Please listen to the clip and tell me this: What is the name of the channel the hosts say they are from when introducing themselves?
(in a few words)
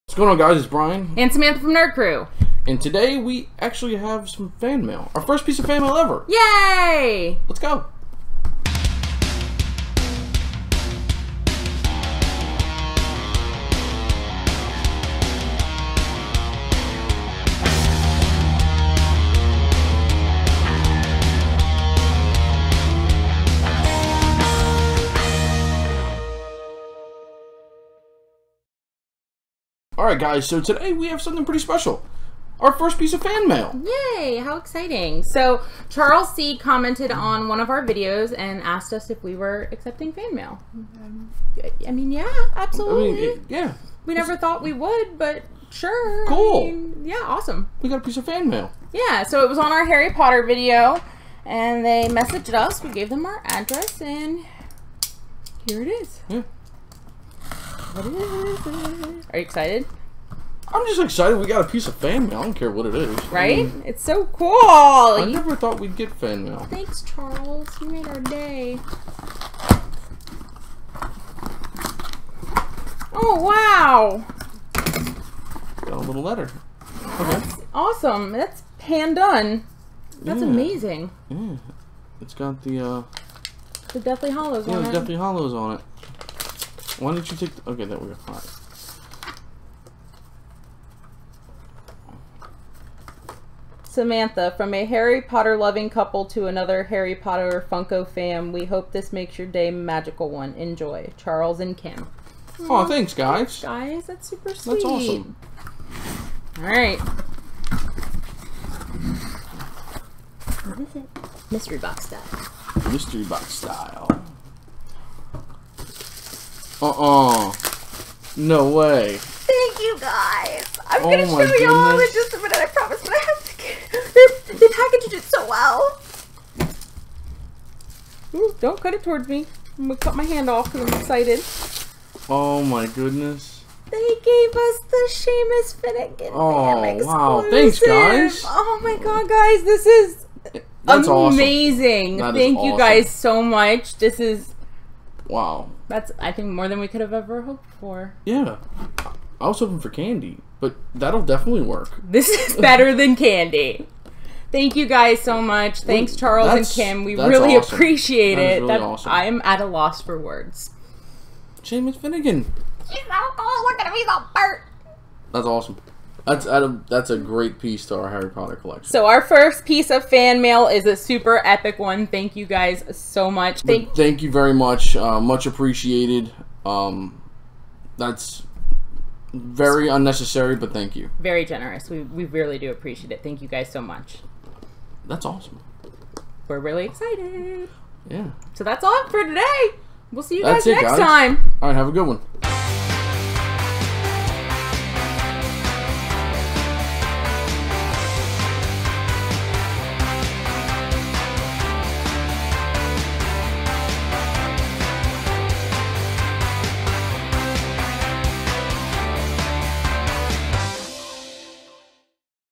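Nerd Krew.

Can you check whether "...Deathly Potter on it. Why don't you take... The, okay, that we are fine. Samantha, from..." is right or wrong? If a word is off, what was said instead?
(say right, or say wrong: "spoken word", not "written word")
wrong: "Hallows", not "Potter".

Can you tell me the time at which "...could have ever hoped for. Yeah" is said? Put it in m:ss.
2:26.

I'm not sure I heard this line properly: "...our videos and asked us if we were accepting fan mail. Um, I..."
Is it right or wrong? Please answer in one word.
right.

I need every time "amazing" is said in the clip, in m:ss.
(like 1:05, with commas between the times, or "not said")
1:20, 2:21.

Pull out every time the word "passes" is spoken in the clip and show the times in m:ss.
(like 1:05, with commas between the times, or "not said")
not said.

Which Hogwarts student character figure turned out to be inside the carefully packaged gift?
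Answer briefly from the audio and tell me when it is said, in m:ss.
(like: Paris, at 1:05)
Seamus Finnigan, at 2:15.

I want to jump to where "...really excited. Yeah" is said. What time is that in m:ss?
3:06.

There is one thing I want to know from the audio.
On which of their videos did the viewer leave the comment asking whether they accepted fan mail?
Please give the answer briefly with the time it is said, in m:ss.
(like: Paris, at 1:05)
Harry Potter video, at 0:49.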